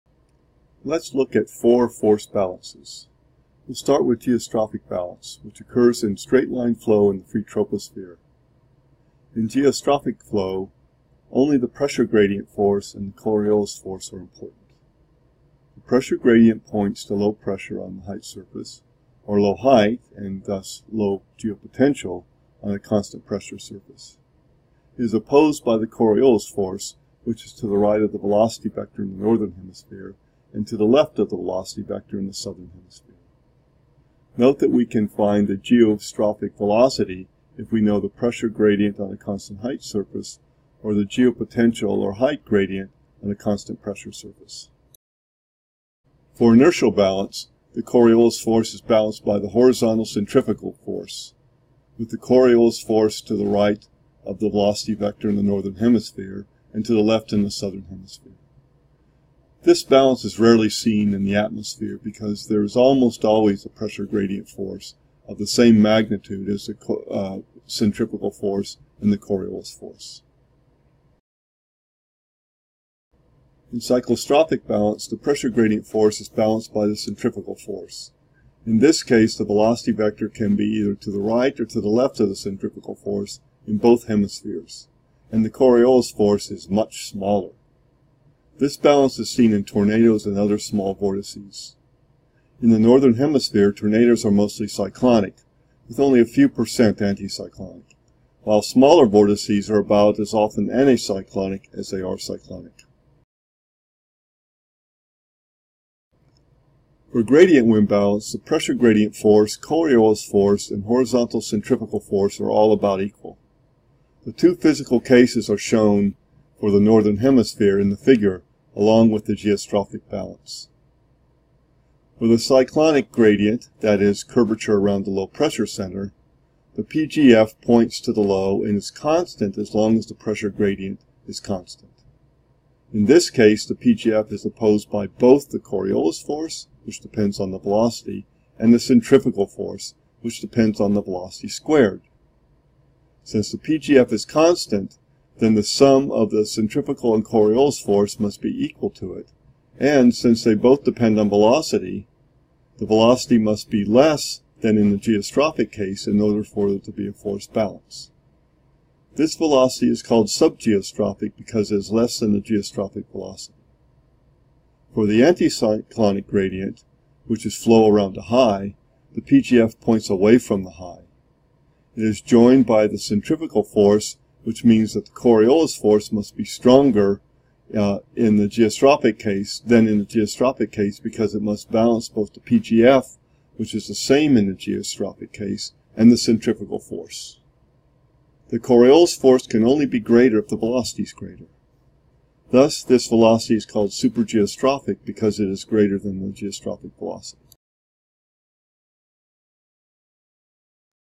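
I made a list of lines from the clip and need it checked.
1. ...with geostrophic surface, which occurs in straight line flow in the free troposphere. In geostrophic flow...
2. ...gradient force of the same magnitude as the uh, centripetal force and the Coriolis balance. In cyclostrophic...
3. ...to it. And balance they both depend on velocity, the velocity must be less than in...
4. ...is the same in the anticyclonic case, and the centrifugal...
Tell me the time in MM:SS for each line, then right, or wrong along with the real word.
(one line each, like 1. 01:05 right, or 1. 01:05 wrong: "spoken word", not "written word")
1. 00:04 wrong: "balance", not "surface"
2. 01:04 wrong: "force", not "balance"
3. 02:28 wrong: "since", not "balance"
4. 03:03 wrong: "geostrophic", not "anticyclonic".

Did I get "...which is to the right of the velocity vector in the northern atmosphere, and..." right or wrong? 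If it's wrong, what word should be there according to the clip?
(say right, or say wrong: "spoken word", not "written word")
wrong: "hemisphere", not "atmosphere".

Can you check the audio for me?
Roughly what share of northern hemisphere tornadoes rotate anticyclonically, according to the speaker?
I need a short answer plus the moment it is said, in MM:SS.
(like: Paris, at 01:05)
A few percent, at 01:36.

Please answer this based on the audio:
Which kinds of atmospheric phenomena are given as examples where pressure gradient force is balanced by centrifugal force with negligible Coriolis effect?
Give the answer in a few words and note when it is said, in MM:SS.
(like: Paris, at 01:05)
Tornadoes and other small vortices, at 01:29.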